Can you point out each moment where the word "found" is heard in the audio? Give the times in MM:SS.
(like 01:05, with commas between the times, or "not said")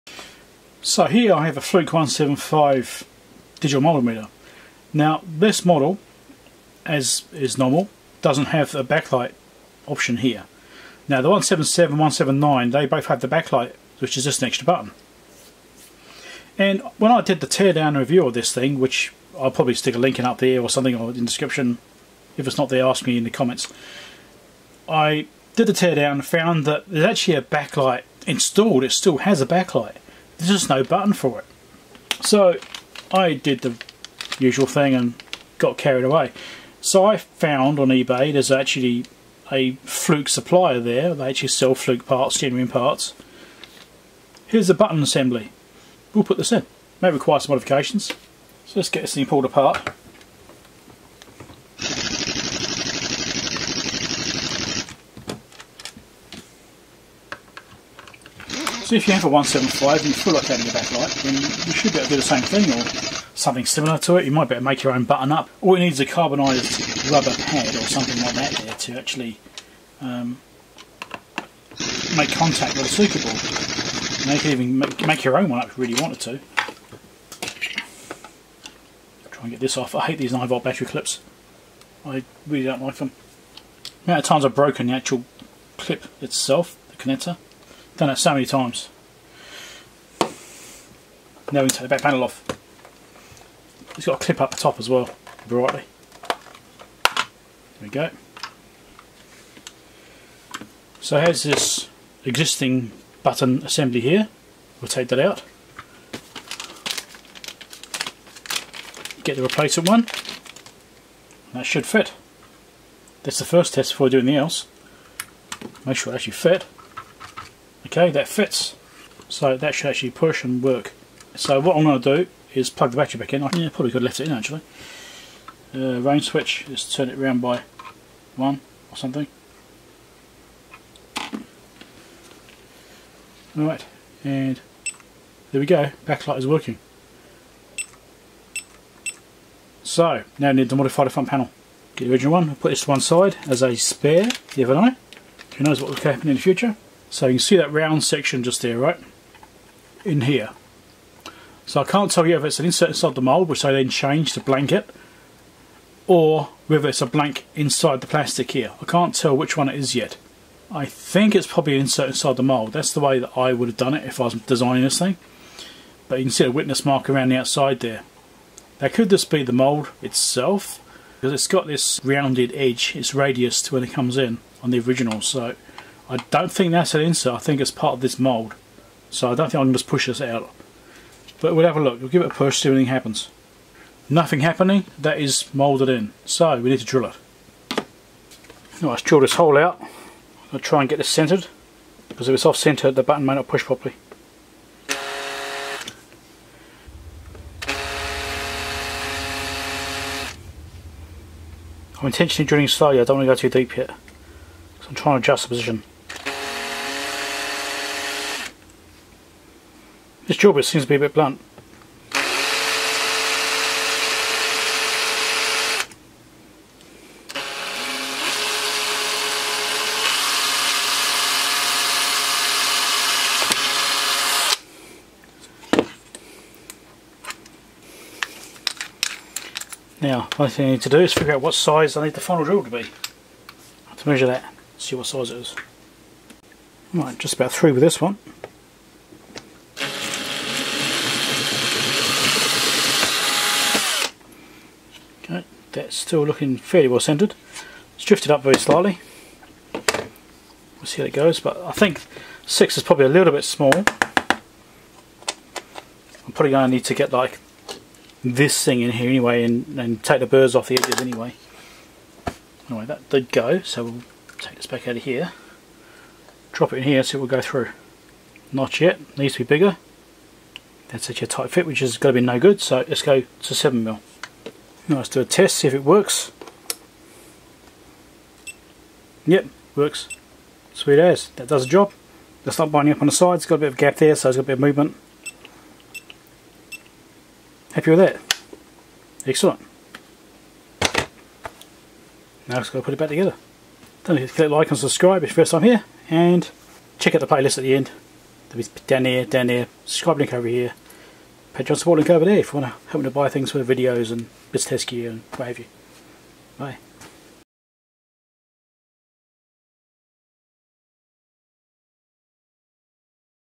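00:26, 00:37.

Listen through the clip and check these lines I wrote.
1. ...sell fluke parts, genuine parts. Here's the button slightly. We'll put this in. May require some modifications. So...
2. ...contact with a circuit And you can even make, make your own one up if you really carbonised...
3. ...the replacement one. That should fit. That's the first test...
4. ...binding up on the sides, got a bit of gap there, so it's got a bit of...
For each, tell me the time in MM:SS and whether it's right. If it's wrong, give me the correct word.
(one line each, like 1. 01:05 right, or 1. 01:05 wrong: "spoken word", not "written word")
1. 00:41 wrong: "assembly", not "slightly"
2. 01:12 wrong: "wanted", not "carbonised"
3. 01:49 right
4. 04:42 right.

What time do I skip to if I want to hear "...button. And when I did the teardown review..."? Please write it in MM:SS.
00:14.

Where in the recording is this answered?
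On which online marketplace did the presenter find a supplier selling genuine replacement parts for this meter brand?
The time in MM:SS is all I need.
00:37.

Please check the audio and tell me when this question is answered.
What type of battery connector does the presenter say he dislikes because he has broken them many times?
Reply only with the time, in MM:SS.
01:20.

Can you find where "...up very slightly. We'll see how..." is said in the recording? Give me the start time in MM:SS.
04:08.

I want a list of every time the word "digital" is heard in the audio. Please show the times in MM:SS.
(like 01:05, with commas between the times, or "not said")
00:03.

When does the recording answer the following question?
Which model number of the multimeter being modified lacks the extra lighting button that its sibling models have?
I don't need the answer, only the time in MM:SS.
00:01.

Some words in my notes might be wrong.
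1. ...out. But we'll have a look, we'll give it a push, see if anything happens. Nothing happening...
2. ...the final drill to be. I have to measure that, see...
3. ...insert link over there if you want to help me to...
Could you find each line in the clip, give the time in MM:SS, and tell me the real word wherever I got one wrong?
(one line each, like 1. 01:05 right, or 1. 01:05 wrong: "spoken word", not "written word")
1. 03:00 right
2. 03:52 right
3. 05:01 wrong: "support", not "insert".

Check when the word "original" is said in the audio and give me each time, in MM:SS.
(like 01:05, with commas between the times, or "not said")
02:22, 02:54.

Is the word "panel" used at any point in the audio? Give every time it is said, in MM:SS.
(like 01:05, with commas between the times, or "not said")
01:32, 02:21.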